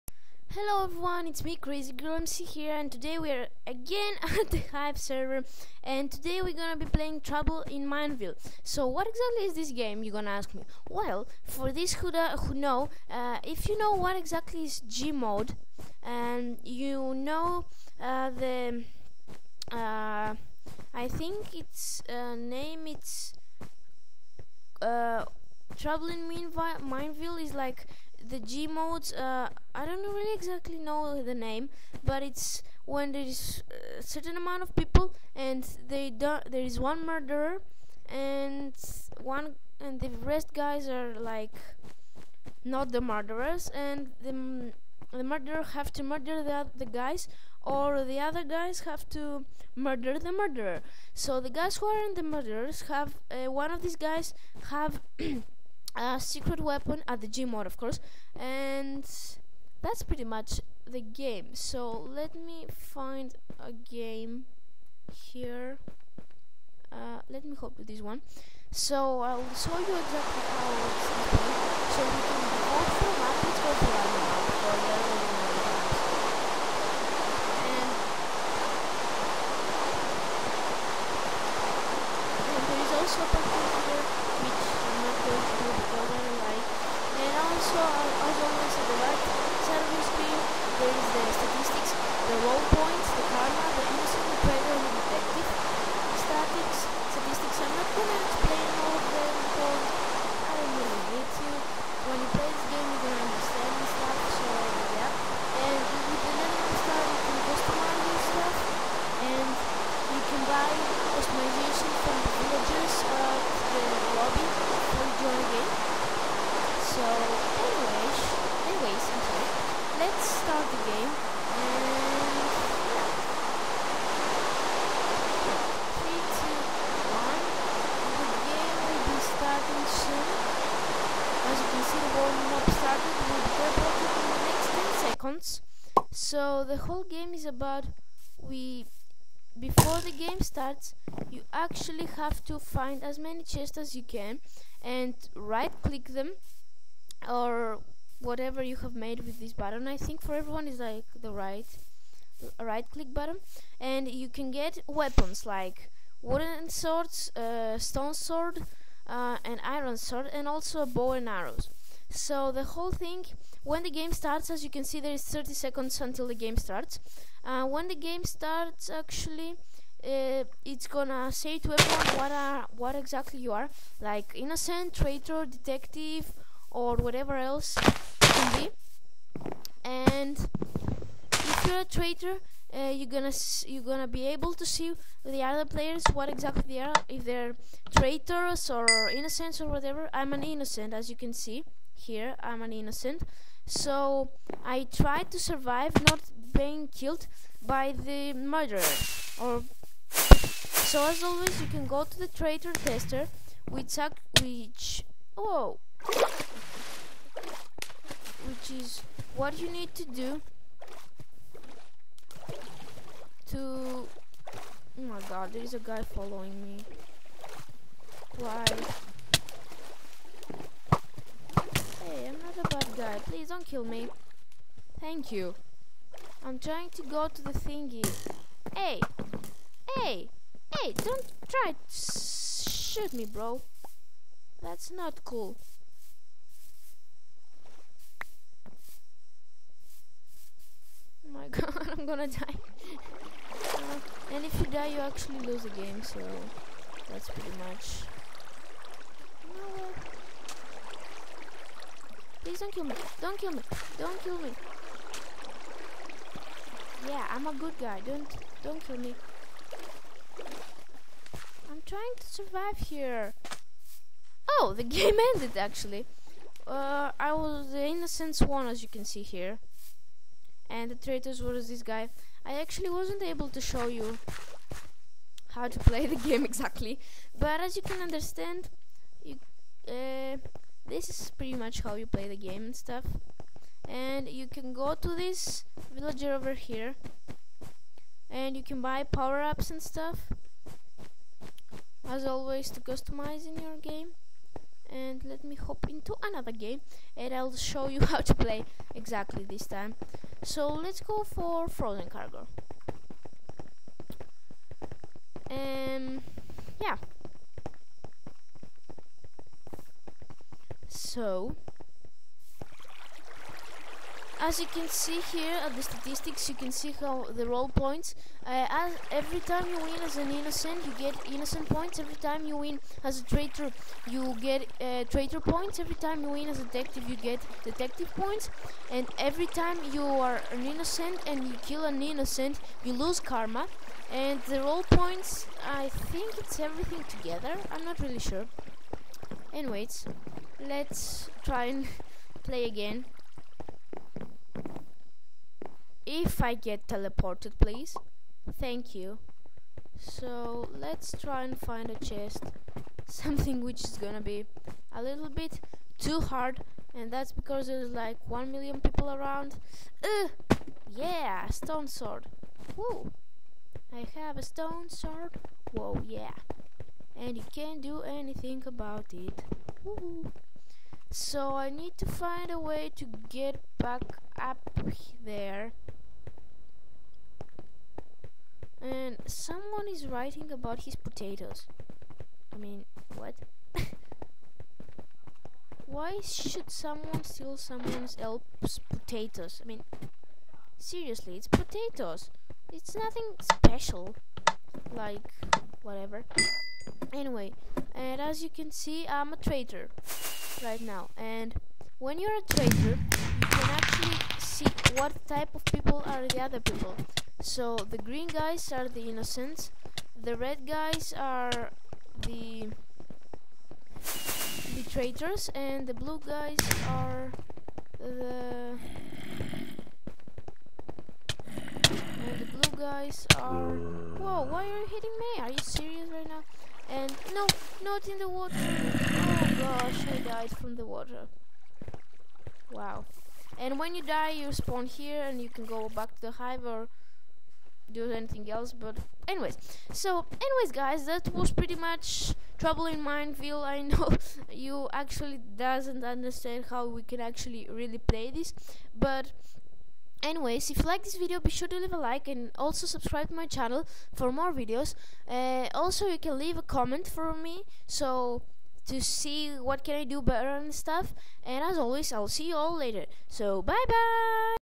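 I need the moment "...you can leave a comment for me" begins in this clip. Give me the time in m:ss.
7:36.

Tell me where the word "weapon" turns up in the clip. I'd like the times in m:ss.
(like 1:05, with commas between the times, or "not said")
0:56, 2:34.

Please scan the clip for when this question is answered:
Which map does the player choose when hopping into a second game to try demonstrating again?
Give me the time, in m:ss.
5:01.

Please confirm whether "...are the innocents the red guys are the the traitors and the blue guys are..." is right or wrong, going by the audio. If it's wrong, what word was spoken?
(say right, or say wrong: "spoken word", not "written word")
right.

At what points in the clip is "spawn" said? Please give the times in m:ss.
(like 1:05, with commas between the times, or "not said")
7:14.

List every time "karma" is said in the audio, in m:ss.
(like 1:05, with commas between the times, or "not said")
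1:33, 5:33.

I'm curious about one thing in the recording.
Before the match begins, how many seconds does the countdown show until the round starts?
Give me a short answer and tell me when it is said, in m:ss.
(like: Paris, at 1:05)
30, at 2:45.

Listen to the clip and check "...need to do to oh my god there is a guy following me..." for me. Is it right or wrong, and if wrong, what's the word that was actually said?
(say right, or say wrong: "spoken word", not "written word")
right.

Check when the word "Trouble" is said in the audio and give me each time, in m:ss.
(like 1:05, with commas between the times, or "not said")
0:07, 0:25, 7:22.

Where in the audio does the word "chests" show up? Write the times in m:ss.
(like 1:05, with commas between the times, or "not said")
2:23, 5:52.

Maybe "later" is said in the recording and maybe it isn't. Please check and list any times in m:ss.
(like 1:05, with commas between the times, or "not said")
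7:42.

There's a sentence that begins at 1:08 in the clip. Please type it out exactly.
So I'll show you exactly how it's played.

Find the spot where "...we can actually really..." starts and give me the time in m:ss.
7:26.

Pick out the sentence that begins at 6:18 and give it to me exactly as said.
And someone is writing about his potatoes.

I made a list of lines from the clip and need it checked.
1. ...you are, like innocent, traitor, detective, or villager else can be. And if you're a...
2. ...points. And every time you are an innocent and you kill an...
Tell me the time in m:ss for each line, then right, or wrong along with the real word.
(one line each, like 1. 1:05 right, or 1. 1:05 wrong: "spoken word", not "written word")
1. 2:53 wrong: "whatever", not "villager"
2. 5:28 right.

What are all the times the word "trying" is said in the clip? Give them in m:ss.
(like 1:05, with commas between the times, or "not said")
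3:46, 4:21.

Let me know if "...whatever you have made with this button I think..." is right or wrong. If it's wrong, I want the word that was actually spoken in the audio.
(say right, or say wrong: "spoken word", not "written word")
right.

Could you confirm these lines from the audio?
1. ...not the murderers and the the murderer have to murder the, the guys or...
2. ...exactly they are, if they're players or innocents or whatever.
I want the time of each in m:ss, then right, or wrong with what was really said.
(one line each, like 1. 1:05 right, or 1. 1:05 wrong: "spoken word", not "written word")
1. 0:42 right
2. 3:06 wrong: "traitors", not "players".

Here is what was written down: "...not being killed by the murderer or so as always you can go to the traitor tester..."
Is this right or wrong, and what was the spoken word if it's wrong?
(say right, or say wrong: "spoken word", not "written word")
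right.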